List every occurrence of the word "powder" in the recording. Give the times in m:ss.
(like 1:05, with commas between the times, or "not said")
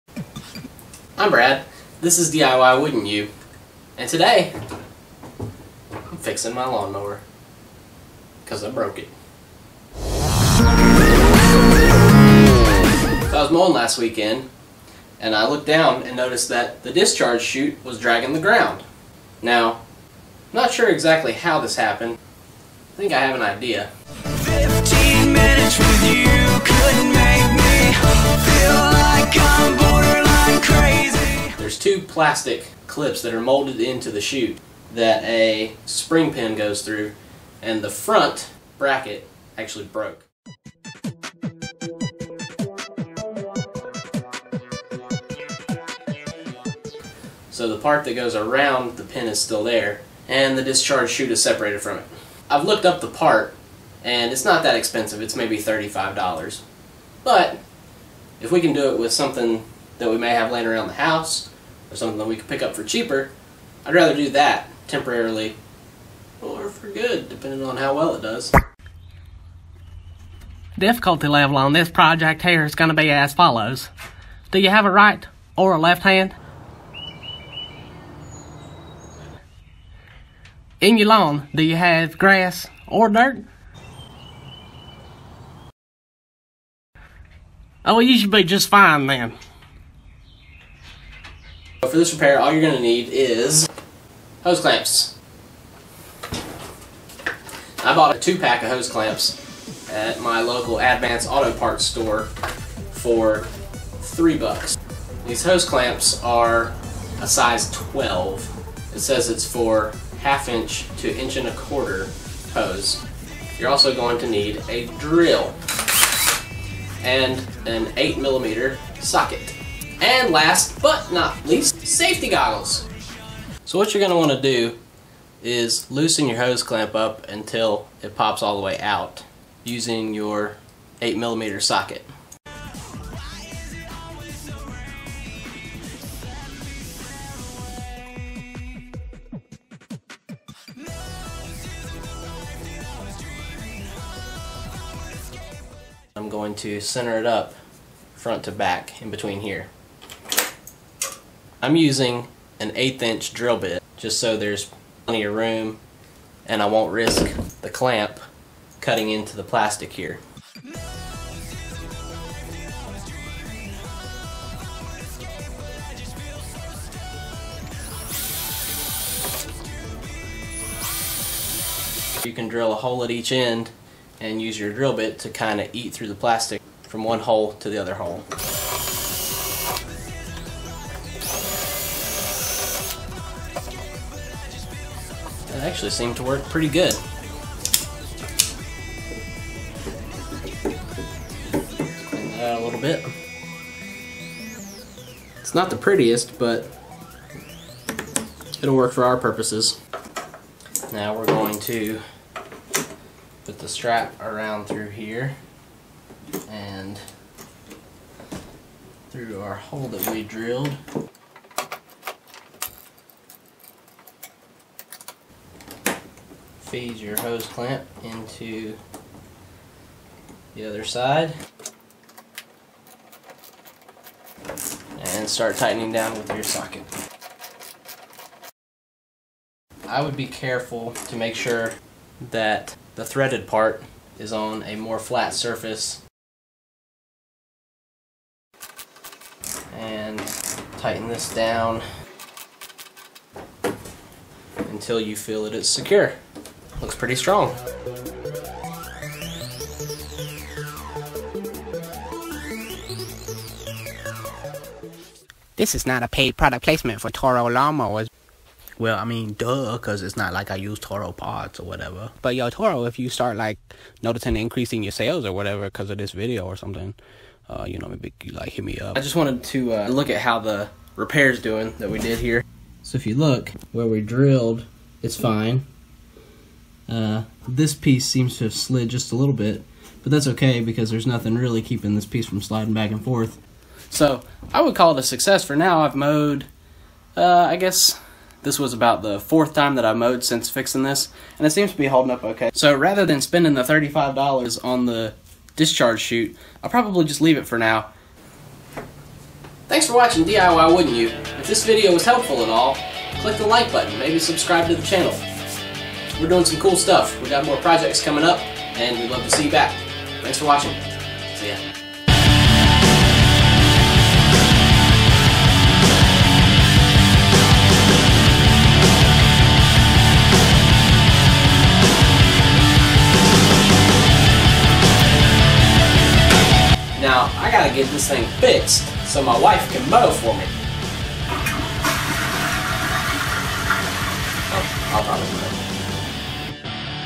not said.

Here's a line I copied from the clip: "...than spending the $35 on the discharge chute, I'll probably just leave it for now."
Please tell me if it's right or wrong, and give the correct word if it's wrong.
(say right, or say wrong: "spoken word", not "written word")
right.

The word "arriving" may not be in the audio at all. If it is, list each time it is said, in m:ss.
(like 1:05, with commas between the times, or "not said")
not said.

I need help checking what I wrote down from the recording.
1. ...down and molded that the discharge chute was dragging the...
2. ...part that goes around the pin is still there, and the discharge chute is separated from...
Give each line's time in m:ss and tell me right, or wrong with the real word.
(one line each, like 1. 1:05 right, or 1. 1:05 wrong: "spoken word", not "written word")
1. 0:15 wrong: "noticed", not "molded"
2. 0:47 right.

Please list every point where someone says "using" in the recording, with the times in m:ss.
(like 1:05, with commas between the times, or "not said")
2:09, 2:31.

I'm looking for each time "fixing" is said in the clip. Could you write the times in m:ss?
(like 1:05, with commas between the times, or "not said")
0:06, 4:50.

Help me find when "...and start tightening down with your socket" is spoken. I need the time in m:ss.
3:44.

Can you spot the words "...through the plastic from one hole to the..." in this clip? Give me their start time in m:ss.
2:55.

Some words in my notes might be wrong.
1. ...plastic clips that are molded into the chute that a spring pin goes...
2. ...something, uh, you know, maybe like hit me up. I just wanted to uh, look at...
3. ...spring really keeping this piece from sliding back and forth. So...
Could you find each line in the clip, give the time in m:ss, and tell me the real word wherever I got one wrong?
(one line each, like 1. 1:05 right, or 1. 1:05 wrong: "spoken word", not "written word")
1. 0:32 right
2. 4:26 right
3. 4:41 wrong: "nothing", not "spring".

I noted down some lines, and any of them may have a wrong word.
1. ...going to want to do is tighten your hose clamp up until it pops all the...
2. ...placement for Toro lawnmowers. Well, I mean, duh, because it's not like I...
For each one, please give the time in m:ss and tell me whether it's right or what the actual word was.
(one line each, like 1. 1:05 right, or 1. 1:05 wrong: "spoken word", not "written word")
1. 2:03 wrong: "loosen", not "tighten"
2. 4:16 right.